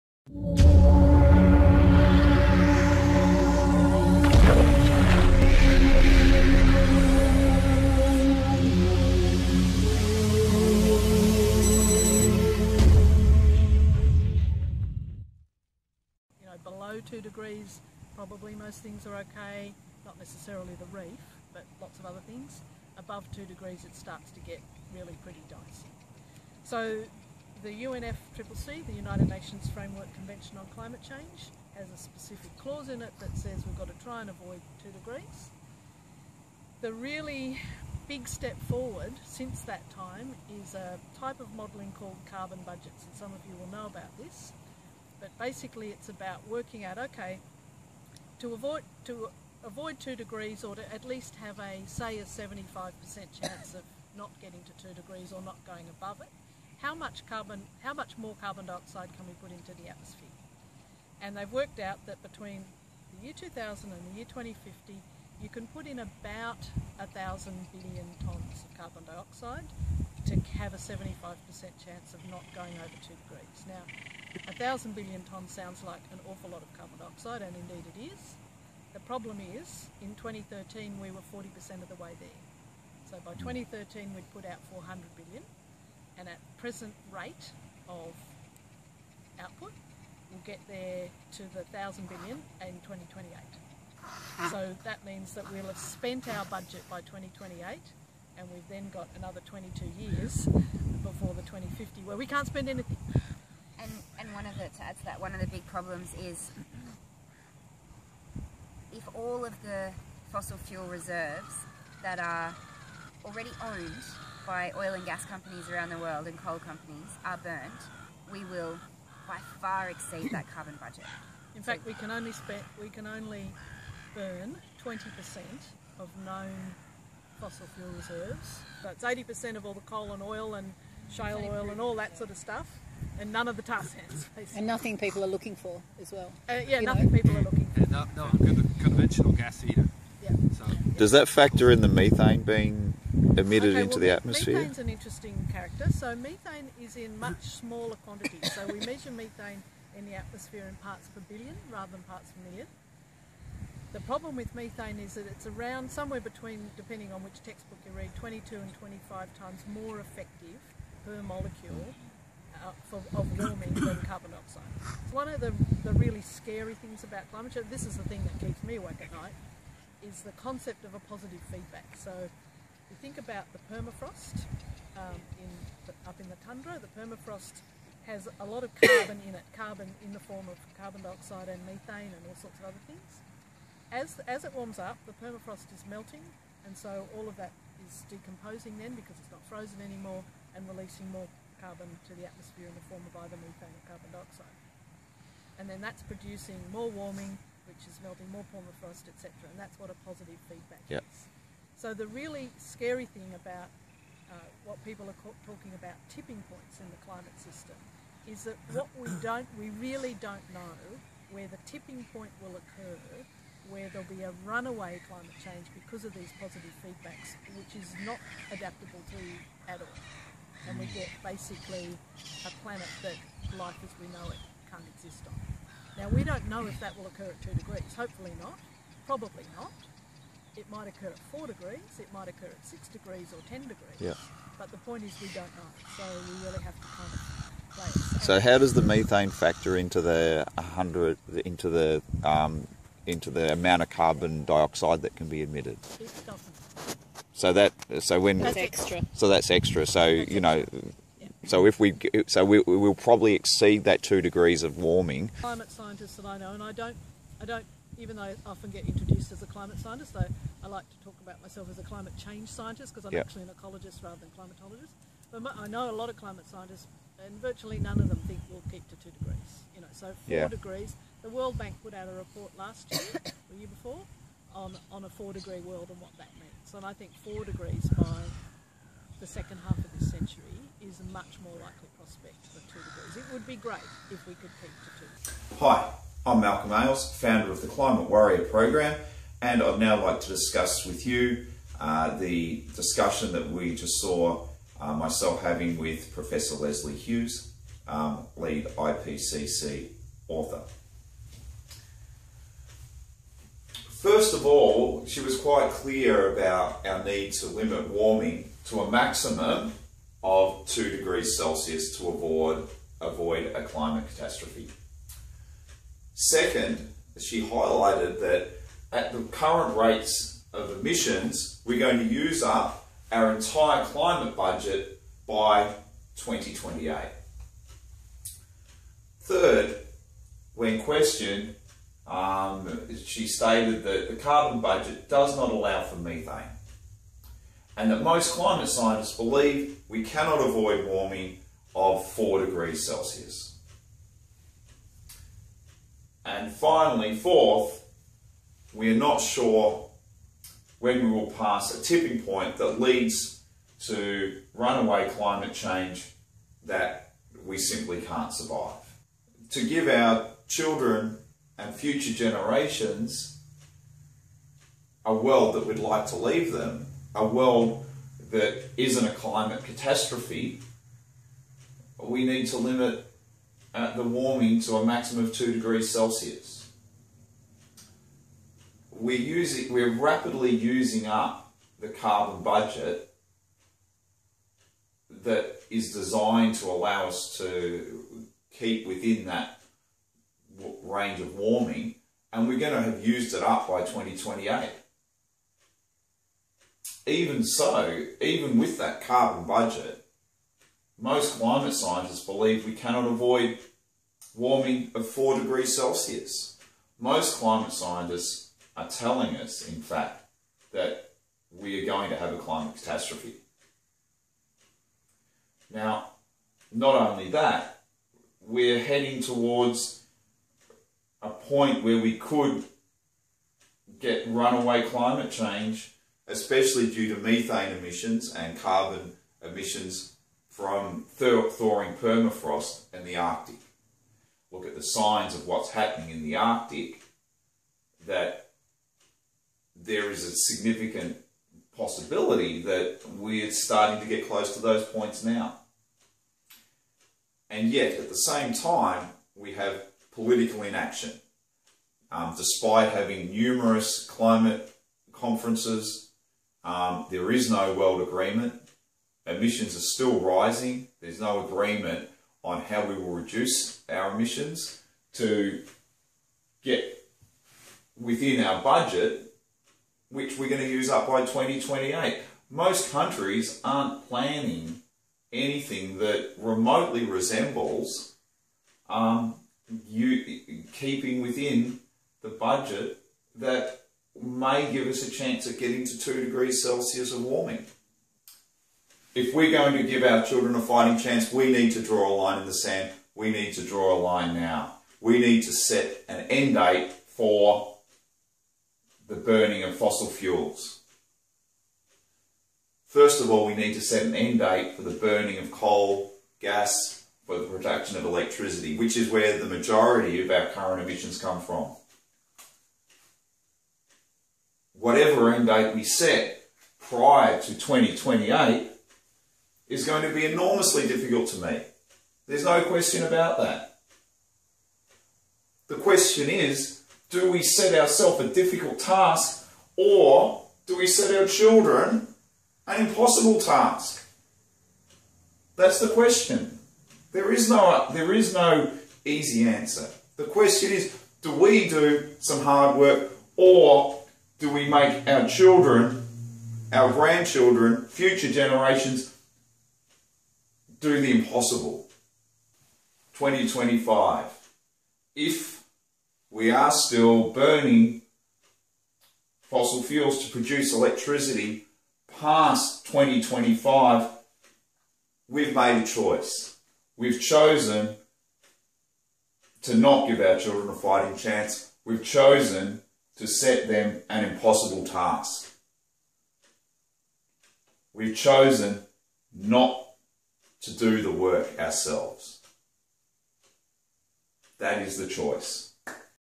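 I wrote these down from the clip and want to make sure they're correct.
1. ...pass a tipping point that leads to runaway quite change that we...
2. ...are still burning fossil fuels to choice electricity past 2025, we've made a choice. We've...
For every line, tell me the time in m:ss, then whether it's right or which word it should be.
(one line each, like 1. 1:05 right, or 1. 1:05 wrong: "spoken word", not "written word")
1. 5:51 wrong: "climate", not "quite"
2. 9:16 wrong: "produce", not "choice".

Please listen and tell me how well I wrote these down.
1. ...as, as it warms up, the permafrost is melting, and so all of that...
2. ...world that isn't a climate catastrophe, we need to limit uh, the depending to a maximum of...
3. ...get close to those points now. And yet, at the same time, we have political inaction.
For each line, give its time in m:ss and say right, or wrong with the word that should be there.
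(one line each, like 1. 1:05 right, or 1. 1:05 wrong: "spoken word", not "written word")
1. 3:03 right
2. 6:07 wrong: "warming", not "depending"
3. 7:24 right.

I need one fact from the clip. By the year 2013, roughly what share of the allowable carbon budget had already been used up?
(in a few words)
40%.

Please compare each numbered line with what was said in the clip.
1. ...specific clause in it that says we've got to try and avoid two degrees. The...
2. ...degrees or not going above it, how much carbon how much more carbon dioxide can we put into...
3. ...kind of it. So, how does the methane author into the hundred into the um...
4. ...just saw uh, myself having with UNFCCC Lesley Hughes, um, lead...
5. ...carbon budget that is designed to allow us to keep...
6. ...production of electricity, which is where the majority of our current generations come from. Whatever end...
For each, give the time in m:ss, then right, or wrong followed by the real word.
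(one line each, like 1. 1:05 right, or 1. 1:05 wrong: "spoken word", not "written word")
1. 0:31 right
2. 0:54 right
3. 3:56 wrong: "factor", not "author"
4. 4:53 wrong: "Professor", not "UNFCCC"
5. 6:21 right
6. 8:27 wrong: "emissions", not "generations".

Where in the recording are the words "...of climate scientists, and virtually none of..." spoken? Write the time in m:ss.
4:26.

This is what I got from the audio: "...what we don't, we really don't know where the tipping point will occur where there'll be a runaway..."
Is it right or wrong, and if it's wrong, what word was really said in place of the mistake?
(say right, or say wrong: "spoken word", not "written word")
right.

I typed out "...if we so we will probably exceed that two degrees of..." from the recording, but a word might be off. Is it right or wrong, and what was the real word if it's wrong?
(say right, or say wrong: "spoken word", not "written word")
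right.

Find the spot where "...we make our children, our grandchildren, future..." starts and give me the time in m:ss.
9:04.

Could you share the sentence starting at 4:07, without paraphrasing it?
So that so when that's extra.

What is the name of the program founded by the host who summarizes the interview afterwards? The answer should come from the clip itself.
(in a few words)
Climate Warrior.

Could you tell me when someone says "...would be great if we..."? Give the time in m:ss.
4:43.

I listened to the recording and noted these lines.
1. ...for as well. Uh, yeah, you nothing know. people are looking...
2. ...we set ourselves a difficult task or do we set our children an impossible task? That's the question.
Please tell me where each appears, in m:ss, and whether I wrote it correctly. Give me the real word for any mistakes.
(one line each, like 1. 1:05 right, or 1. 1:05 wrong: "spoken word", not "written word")
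1. 2:15 right
2. 8:47 right.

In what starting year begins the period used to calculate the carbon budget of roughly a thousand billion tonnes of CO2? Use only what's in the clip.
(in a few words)
2000.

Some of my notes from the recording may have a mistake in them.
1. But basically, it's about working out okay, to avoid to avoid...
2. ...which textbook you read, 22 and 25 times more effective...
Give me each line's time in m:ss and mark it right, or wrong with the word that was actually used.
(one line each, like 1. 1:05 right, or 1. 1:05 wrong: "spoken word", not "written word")
1. 0:45 right
2. 2:37 right.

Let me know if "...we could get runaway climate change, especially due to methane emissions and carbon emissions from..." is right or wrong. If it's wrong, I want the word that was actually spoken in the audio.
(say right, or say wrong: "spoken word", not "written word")
right.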